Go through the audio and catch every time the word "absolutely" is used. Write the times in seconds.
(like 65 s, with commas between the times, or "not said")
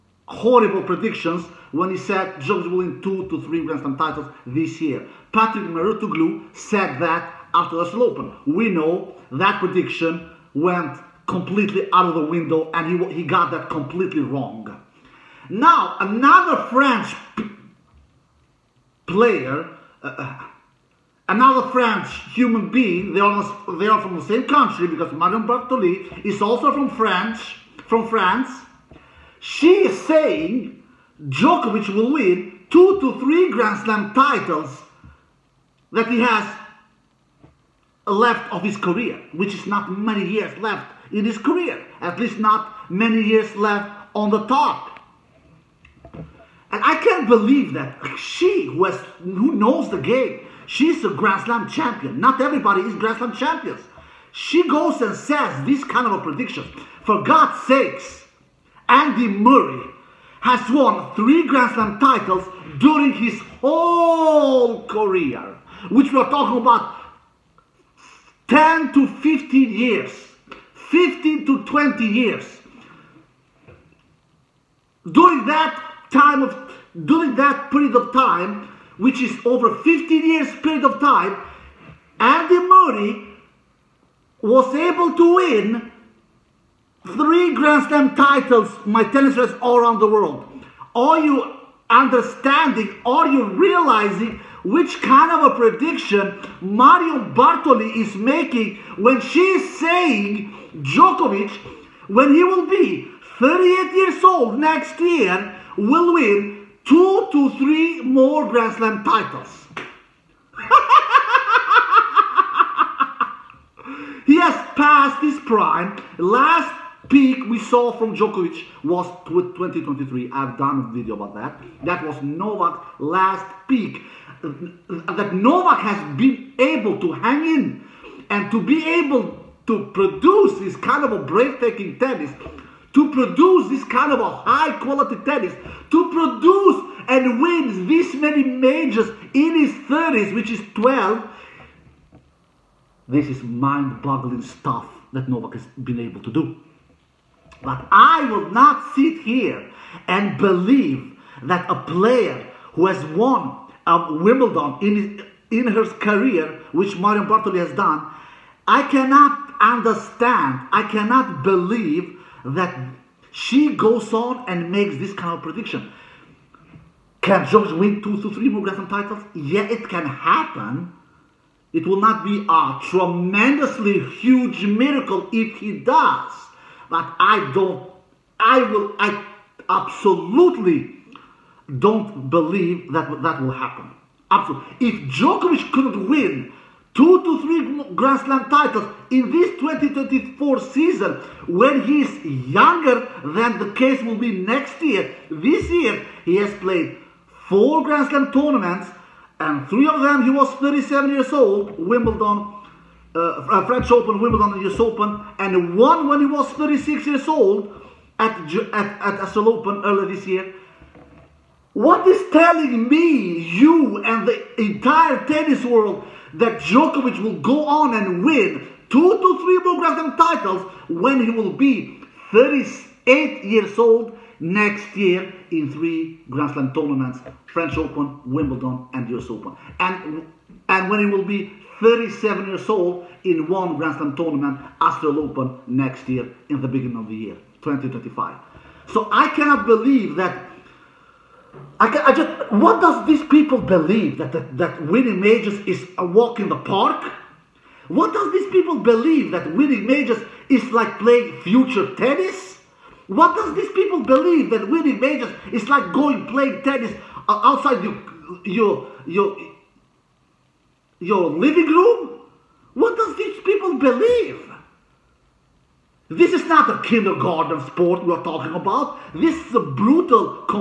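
179 s, 184 s.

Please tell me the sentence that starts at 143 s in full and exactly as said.
This is mind boggling stuff that Novak has been able to do.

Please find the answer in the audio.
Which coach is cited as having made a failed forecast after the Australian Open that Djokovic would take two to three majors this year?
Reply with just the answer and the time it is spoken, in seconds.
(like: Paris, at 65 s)
Patrick Mouratoglou, at 5 s.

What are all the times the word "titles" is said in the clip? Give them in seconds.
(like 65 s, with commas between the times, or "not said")
3 s, 34 s, 61 s, 88 s, 109 s, 168 s, 188 s, 220 s.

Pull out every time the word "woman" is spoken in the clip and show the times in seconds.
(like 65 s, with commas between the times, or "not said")
not said.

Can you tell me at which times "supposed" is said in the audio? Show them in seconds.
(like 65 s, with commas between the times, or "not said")
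not said.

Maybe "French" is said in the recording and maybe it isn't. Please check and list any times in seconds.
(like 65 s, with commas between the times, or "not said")
16 s, 21 s, 203 s, 227 s.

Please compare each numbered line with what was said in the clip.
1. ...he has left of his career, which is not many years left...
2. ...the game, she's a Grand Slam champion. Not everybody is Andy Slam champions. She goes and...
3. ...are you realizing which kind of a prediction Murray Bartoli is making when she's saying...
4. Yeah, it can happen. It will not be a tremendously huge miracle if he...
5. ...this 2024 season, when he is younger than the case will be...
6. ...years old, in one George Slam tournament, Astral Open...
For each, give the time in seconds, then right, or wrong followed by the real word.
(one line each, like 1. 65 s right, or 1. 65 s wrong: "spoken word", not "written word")
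1. 36 s right
2. 49 s wrong: "Grand", not "Andy"
3. 93 s wrong: "Mario", not "Murray"
4. 169 s right
5. 189 s right
6. 232 s wrong: "Grand", not "George".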